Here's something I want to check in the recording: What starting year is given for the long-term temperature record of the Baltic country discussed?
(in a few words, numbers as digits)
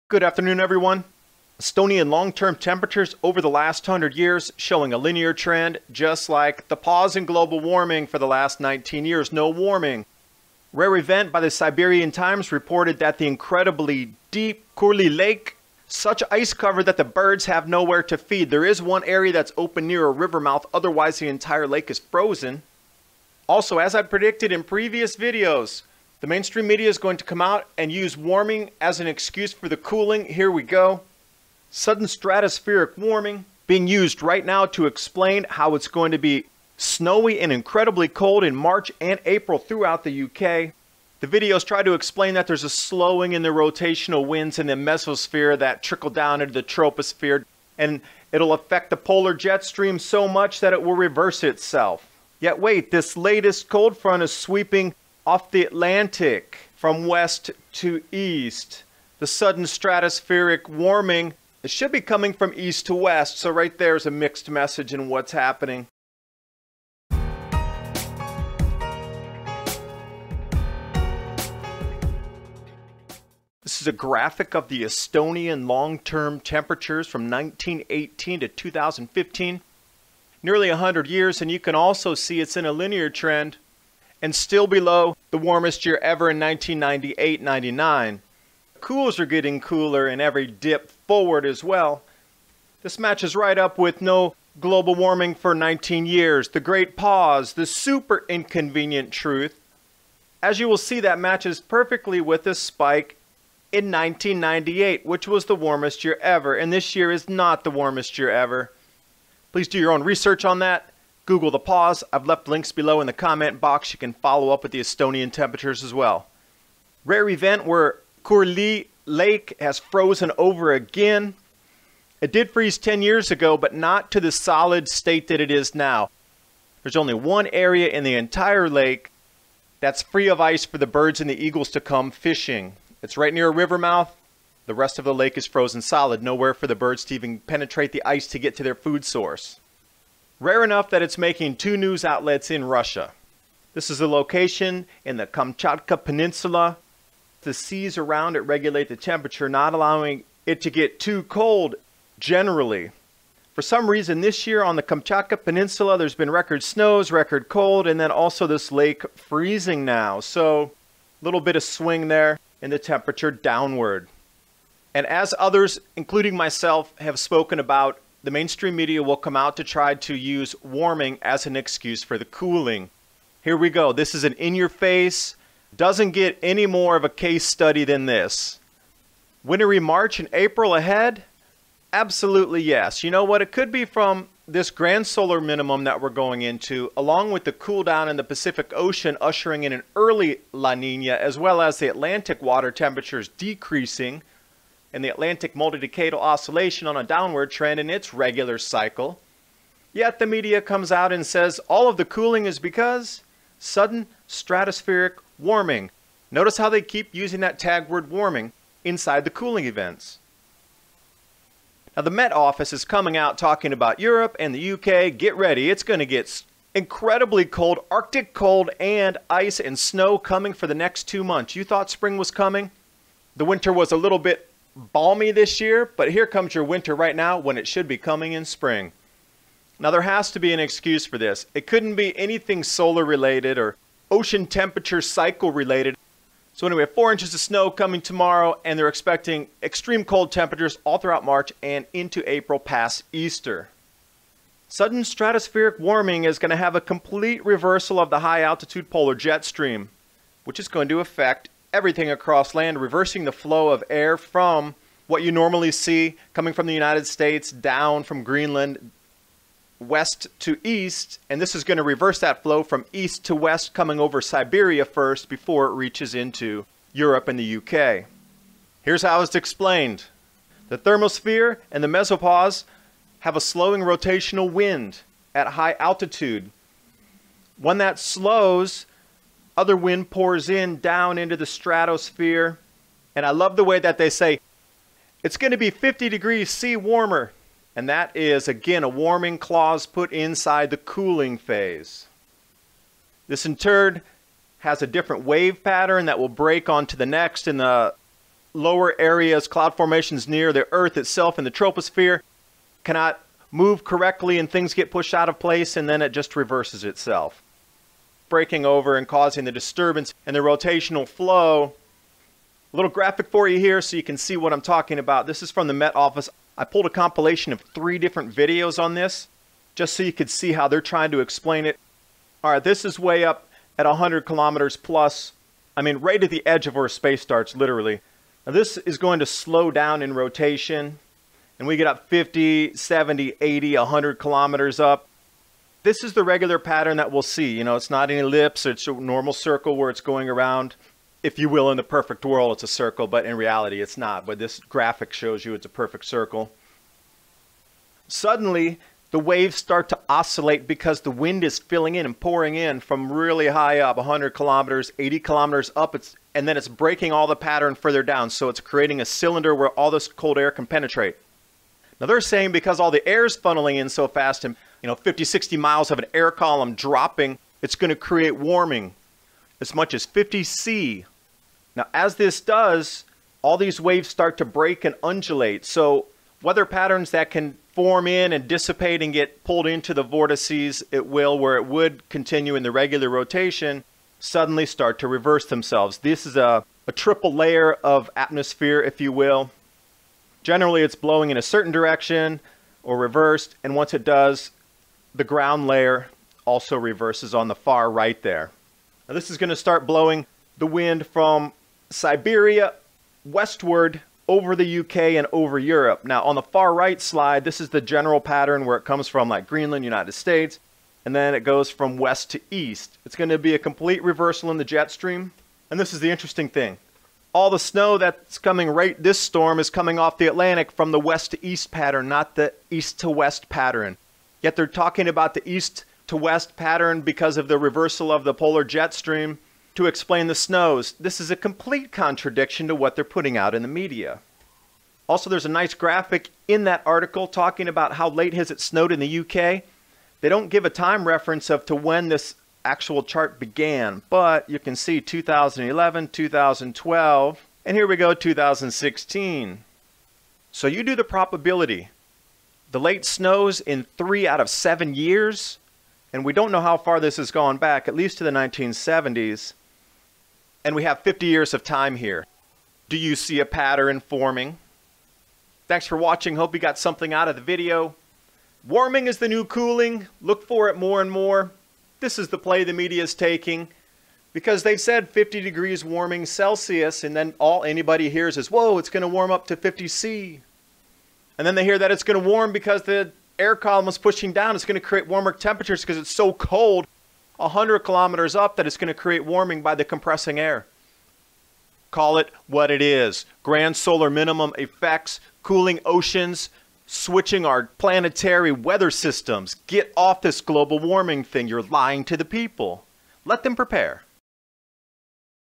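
1918.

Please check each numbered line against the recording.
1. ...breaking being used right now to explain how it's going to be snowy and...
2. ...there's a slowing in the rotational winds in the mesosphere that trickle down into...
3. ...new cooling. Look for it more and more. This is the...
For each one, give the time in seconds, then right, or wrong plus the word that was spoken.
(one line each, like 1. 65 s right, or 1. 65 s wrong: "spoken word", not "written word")
1. 32 s wrong: "warming", not "breaking"
2. 42 s right
3. 469 s right.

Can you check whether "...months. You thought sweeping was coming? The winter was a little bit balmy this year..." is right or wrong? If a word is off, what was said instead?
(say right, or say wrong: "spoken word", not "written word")
wrong: "spring", not "sweeping".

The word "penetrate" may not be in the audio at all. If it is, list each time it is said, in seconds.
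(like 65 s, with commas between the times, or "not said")
137 s, 360 s.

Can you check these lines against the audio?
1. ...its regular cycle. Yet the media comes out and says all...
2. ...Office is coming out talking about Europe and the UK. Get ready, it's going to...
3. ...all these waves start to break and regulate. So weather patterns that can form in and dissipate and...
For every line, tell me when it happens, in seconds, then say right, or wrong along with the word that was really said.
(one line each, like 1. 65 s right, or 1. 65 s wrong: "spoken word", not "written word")
1. 197 s right
2. 212 s right
3. 373 s wrong: "undulate", not "regulate".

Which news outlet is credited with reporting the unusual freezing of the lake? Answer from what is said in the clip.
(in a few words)
Siberian Times.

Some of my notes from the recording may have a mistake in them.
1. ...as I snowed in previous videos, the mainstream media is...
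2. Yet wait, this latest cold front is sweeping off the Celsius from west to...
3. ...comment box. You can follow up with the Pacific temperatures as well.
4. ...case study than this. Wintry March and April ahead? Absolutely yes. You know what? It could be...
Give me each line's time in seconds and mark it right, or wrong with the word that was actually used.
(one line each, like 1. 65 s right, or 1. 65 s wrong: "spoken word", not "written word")
1. 23 s wrong: "predicted", not "snowed"
2. 52 s wrong: "Atlantic", not "Celsius"
3. 113 s wrong: "Estonian", not "Pacific"
4. 177 s right.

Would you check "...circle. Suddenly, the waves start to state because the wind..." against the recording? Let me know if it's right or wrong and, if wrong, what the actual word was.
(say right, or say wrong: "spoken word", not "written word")
wrong: "oscillate", not "state".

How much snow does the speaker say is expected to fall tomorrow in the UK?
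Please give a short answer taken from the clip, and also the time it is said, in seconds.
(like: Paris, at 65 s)
4 inches, at 236 s.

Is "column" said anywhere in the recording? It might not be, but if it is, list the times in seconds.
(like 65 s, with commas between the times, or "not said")
366 s, 483 s.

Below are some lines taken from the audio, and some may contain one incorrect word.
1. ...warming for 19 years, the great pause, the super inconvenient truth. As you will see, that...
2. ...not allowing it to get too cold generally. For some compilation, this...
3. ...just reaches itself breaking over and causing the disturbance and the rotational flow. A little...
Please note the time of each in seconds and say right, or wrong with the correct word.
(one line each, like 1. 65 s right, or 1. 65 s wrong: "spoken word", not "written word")
1. 94 s right
2. 149 s wrong: "reason", not "compilation"
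3. 306 s wrong: "reverses", not "reaches".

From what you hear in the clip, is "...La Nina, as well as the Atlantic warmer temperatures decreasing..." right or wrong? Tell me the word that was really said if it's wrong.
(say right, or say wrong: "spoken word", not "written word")
wrong: "water", not "warmer".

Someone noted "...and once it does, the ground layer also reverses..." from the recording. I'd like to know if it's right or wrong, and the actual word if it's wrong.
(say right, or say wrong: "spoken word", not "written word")
right.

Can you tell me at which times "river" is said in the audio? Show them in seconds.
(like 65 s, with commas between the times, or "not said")
20 s, 133 s.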